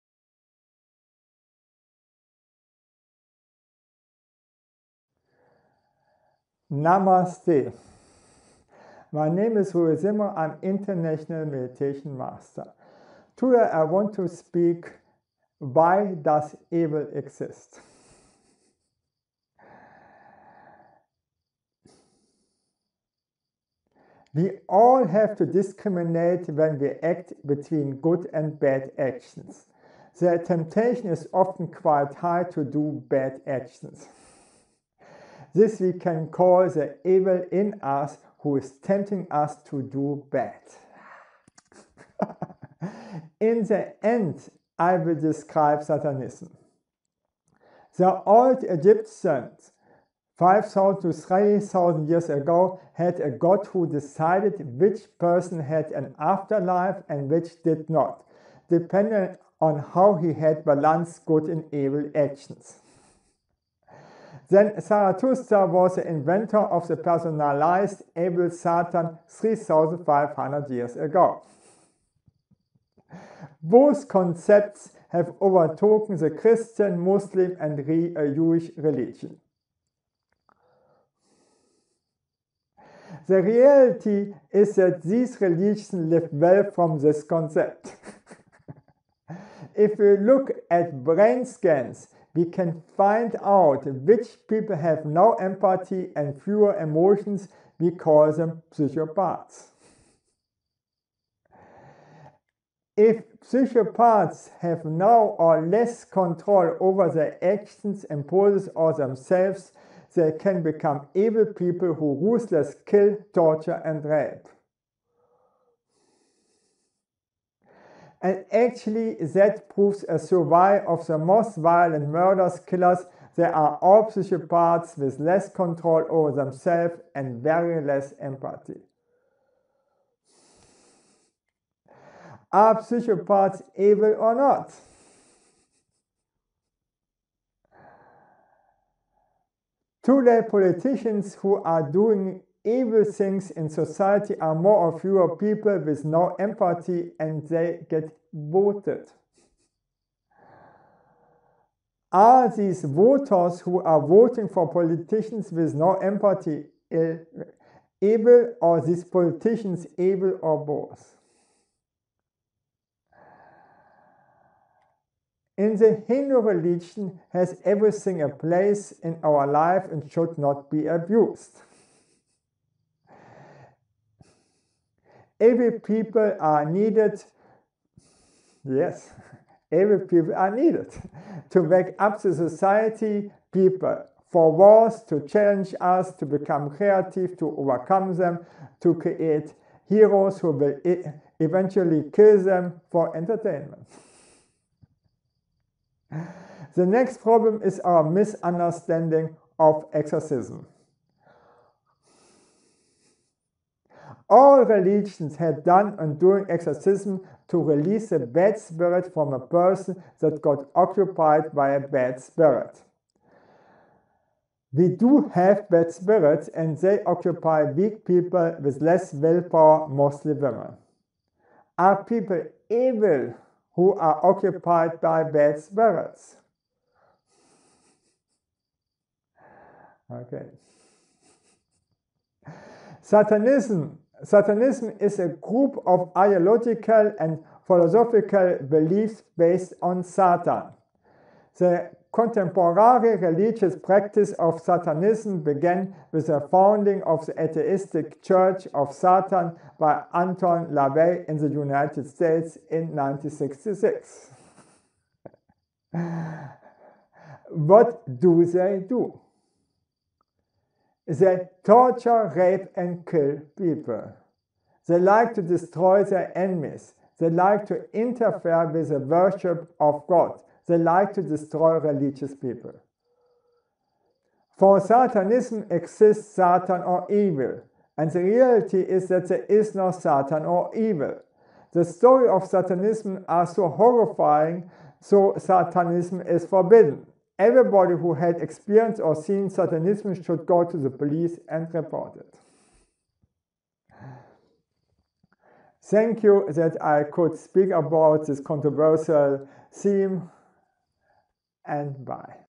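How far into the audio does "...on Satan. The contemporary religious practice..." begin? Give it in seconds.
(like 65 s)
239 s.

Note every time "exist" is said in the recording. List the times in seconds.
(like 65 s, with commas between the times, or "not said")
17 s, 275 s.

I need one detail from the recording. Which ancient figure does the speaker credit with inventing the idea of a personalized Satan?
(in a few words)
Zarathustra.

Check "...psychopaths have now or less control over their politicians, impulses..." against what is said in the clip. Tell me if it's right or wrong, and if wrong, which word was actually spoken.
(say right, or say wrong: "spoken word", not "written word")
wrong: "actions", not "politicians".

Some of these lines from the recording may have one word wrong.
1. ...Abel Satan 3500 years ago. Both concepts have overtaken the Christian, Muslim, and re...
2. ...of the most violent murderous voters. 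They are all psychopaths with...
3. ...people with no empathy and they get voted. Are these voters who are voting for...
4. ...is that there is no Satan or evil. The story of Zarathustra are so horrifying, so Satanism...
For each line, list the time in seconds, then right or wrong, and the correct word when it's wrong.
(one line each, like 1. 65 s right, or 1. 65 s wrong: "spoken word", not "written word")
1. 68 s right
2. 120 s wrong: "killers", not "voters"
3. 145 s right
4. 278 s wrong: "Satanism", not "Zarathustra".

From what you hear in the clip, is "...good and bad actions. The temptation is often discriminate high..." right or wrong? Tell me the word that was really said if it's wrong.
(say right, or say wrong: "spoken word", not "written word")
wrong: "quite", not "discriminate".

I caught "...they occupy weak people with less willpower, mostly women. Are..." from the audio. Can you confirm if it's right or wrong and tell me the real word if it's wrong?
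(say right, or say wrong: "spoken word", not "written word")
right.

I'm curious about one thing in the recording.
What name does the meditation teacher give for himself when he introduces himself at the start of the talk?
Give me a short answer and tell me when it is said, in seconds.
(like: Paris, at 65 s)
Rudi Zimmerer, at 9 s.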